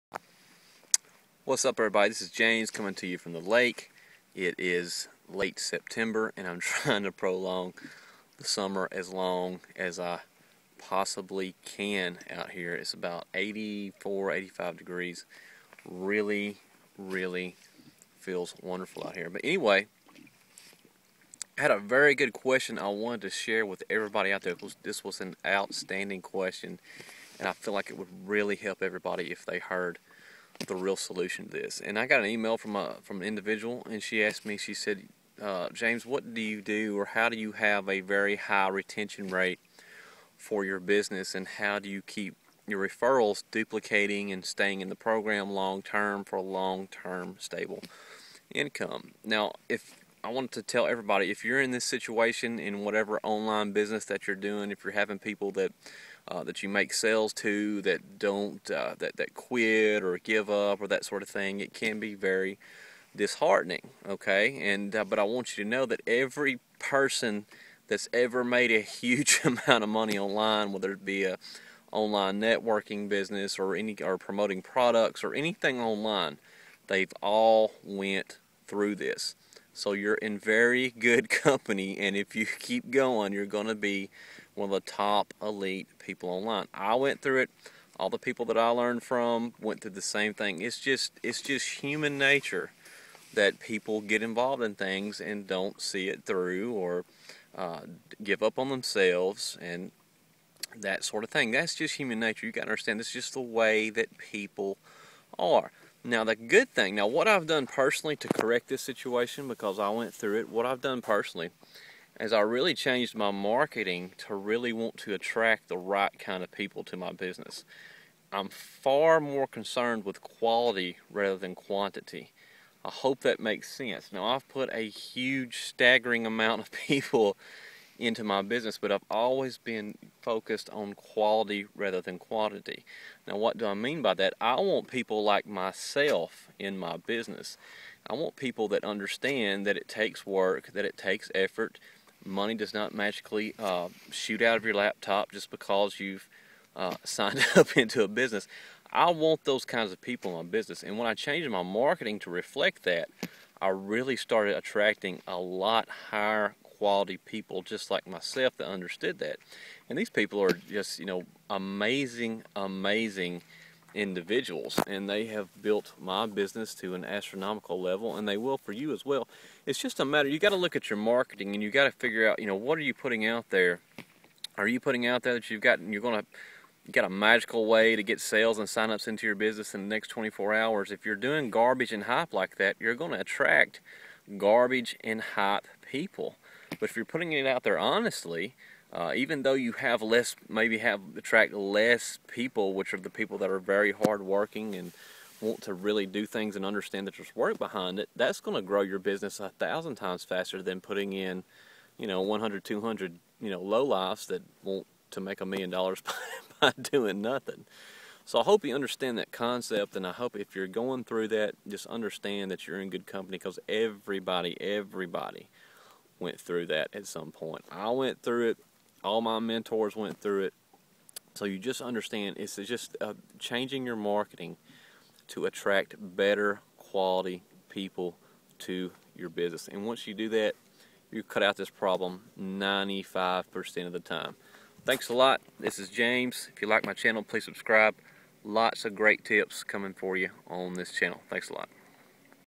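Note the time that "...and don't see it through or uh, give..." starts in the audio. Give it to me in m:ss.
1:35.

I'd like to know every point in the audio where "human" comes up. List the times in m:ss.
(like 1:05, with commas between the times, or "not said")
1:31, 1:41.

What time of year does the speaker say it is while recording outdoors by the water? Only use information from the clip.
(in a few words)
late September.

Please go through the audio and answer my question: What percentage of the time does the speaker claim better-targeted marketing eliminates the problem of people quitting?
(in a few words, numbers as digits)
95%.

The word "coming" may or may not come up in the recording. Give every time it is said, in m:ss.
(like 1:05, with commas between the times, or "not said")
0:02, 3:59.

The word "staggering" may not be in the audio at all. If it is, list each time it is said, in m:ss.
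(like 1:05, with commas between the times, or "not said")
2:05.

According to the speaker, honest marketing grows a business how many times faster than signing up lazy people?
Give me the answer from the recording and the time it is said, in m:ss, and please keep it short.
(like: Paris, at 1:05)
1000 times, at 3:19.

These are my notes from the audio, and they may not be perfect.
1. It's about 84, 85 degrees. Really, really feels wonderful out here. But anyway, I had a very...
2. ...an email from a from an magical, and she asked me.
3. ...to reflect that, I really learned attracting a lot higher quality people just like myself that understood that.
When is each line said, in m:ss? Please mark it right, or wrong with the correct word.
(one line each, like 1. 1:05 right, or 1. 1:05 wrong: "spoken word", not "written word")
1. 0:12 right
2. 0:32 wrong: "individual", not "magical"
3. 2:32 wrong: "started", not "learned".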